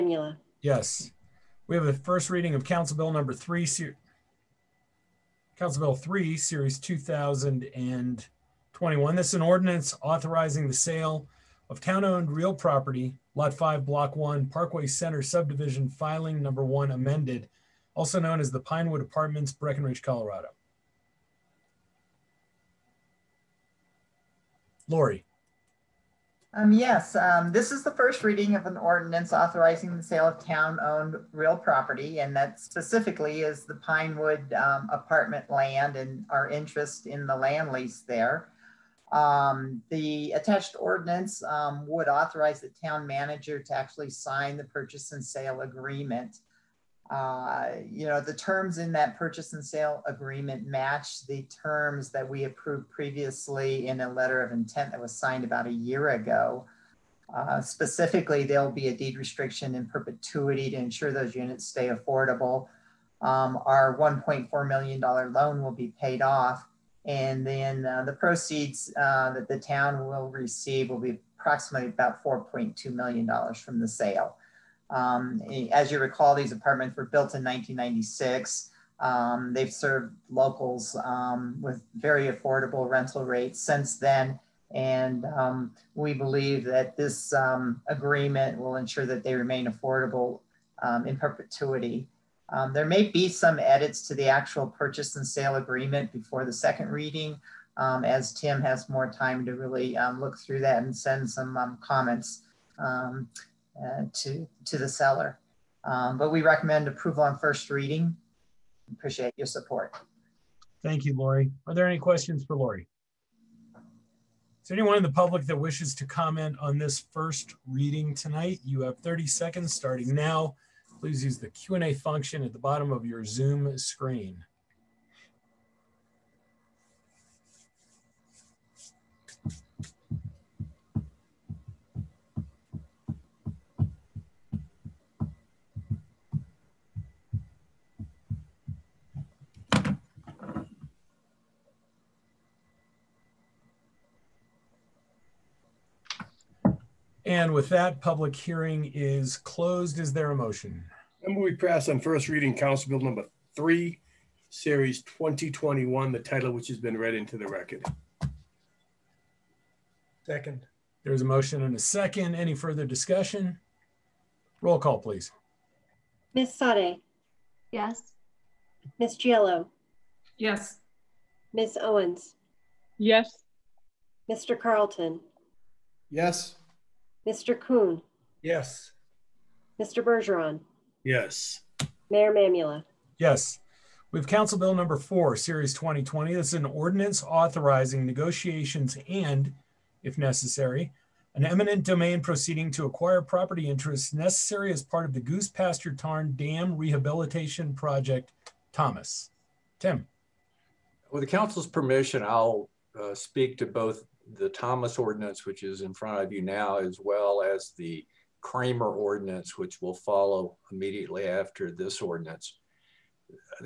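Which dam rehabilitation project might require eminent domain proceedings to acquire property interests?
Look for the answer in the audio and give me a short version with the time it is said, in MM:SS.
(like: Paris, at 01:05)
Goose Pasture Tarn, at 03:15.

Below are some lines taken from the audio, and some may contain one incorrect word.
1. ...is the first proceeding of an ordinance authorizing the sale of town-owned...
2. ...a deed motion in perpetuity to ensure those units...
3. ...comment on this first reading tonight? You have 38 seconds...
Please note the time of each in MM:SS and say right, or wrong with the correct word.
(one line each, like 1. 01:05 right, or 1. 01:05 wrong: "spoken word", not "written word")
1. 00:27 wrong: "reading", not "proceeding"
2. 00:58 wrong: "restriction", not "motion"
3. 01:56 wrong: "30", not "38".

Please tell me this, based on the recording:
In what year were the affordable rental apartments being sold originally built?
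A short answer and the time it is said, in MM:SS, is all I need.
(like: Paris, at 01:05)
1996, at 01:17.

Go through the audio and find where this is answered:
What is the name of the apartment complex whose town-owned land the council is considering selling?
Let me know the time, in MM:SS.
00:18.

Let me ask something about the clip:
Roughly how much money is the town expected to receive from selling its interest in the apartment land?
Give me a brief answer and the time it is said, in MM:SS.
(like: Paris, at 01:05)
$4.2 million, at 01:12.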